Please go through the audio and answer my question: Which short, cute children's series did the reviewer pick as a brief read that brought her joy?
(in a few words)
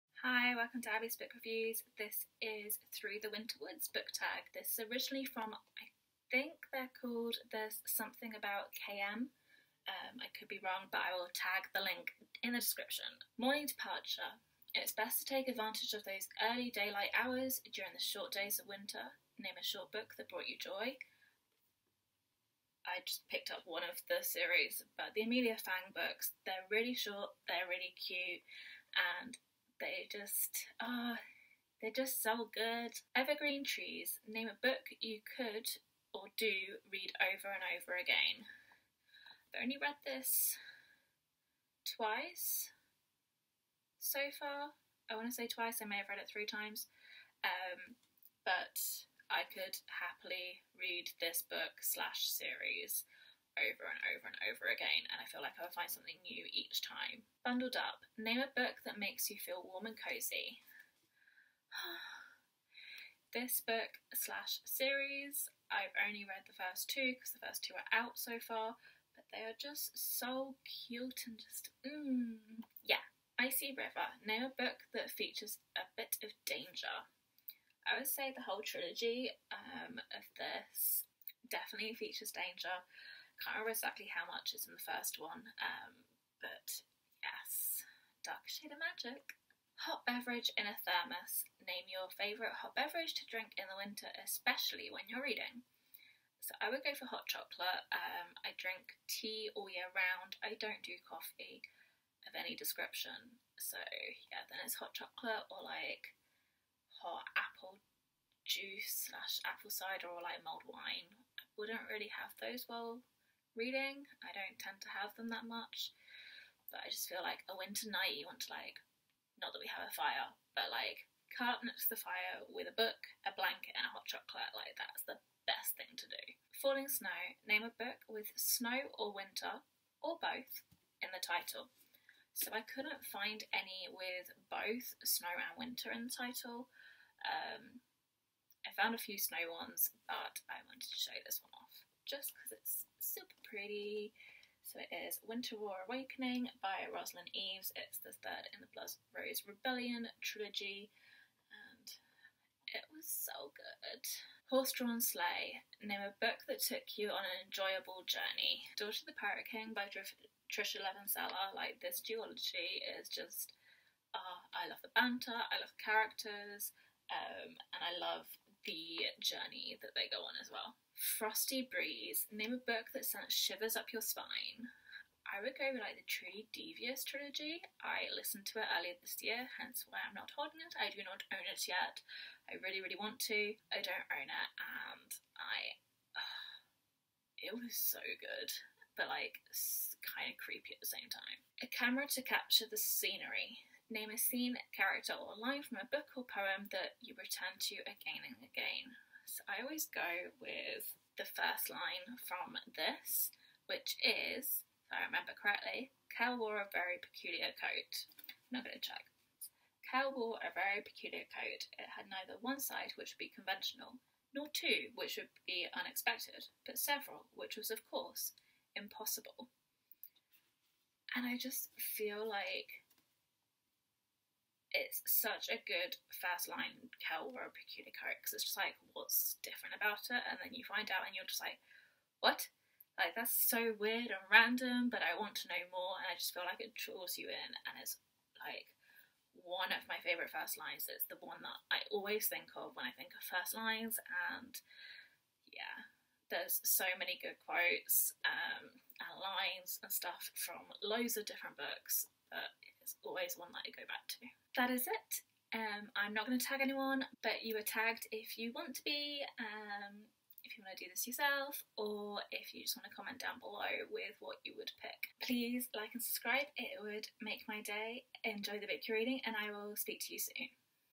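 Amelia Fang.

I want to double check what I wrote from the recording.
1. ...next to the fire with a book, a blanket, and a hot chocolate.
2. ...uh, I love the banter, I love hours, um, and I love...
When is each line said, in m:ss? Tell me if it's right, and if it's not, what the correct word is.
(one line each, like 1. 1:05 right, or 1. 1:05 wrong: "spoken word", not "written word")
1. 2:01 right
2. 2:44 wrong: "characters", not "hours".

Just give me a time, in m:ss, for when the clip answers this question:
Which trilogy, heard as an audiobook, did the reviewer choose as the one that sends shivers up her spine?
2:56.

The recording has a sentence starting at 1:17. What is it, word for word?
I would say the whole trilogy um, of this definitely features danger.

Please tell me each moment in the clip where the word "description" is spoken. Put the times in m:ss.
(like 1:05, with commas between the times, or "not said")
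0:12, 1:42.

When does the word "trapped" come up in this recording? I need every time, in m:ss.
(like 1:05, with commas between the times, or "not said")
not said.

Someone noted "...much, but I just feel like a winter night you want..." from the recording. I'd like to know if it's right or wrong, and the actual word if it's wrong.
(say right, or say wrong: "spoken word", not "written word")
right.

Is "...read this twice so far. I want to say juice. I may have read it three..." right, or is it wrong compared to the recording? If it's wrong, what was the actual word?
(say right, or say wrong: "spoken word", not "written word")
wrong: "twice", not "juice".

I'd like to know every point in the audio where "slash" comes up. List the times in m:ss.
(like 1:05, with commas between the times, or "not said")
0:51, 1:04, 1:49.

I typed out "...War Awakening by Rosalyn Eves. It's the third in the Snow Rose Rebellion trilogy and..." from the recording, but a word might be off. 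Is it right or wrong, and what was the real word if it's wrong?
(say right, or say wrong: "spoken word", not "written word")
wrong: "Blood", not "Snow".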